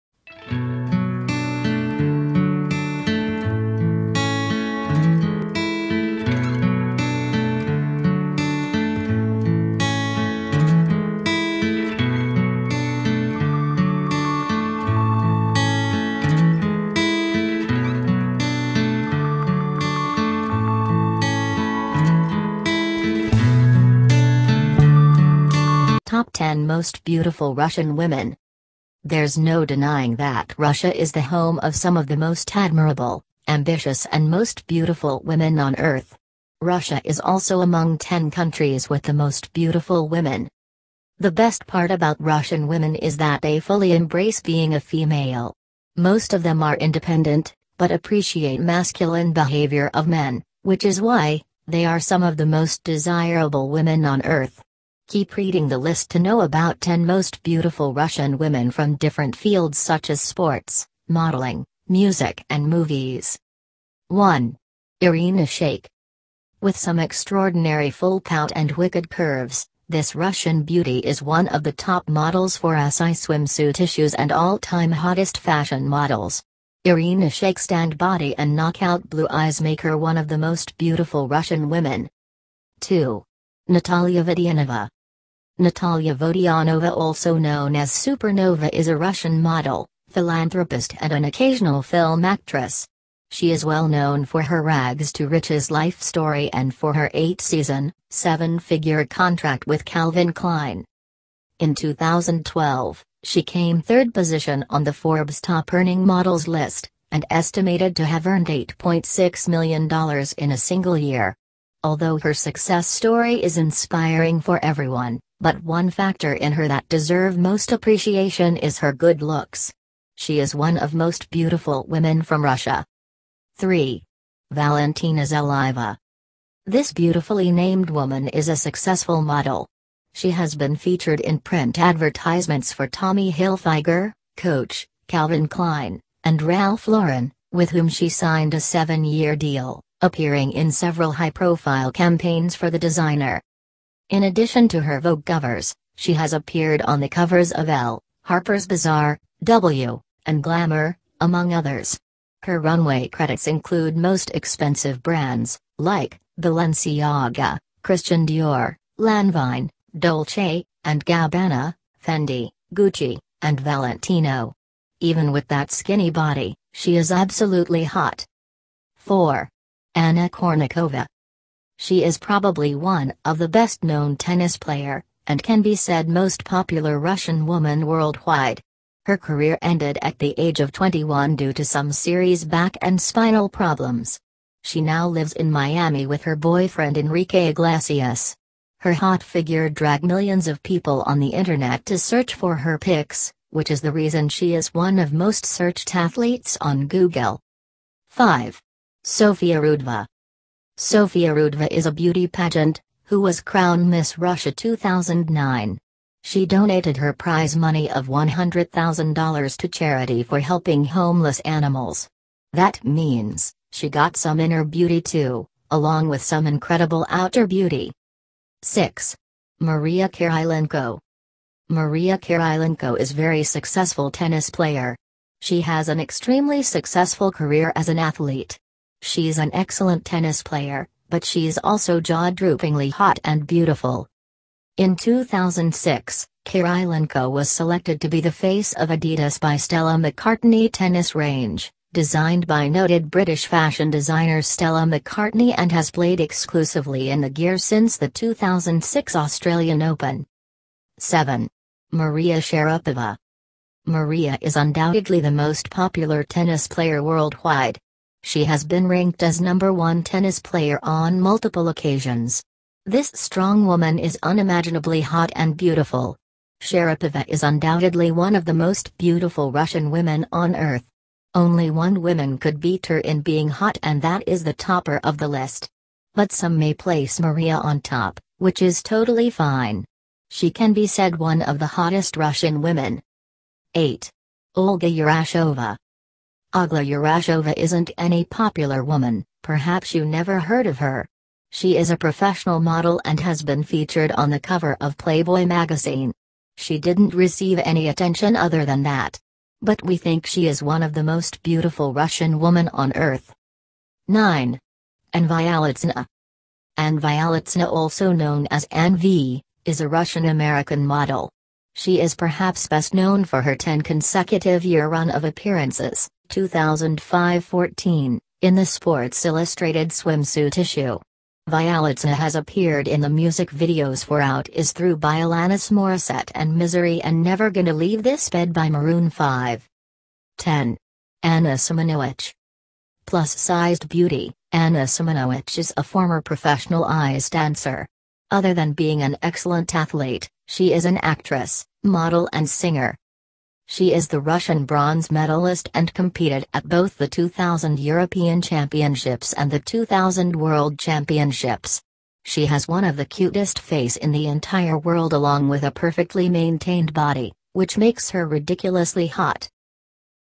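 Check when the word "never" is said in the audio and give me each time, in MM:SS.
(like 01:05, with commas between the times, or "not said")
04:50, 05:27.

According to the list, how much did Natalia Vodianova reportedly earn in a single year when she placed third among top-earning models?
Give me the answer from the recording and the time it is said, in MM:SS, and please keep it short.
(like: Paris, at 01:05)
$8.6 million, at 01:48.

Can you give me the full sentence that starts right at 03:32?
That means, she got some inner beauty too, along with some incredible outer beauty.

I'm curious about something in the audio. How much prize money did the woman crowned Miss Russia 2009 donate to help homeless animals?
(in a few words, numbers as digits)
$100,000.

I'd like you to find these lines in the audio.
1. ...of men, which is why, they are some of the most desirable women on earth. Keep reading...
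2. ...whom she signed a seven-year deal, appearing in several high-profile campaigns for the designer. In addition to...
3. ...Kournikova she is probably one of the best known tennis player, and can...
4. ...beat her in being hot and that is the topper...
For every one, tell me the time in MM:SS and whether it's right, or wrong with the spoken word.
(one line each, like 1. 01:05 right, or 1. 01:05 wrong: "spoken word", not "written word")
1. 00:49 right
2. 02:17 right
3. 02:50 right
4. 04:32 right.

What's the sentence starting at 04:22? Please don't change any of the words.
This strong woman is unimaginably hot and beautiful.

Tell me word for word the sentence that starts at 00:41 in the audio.
The best part about Russian women is that they fully embrace being a female.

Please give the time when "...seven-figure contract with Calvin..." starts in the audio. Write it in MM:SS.
01:38.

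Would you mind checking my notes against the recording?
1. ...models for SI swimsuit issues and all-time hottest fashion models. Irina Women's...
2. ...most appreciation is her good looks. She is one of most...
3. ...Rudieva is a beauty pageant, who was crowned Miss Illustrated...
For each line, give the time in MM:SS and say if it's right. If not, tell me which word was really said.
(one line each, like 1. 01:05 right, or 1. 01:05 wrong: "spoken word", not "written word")
1. 01:12 wrong: "Shayk", not "Women"
2. 01:57 right
3. 03:21 wrong: "Russia", not "Illustrated".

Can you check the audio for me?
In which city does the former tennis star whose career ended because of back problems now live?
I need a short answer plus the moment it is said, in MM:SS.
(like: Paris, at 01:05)
Miami, at 03:05.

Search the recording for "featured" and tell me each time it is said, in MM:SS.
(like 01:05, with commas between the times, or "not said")
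02:10, 04:53.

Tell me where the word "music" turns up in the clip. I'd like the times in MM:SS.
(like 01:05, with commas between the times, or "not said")
01:01, 05:23.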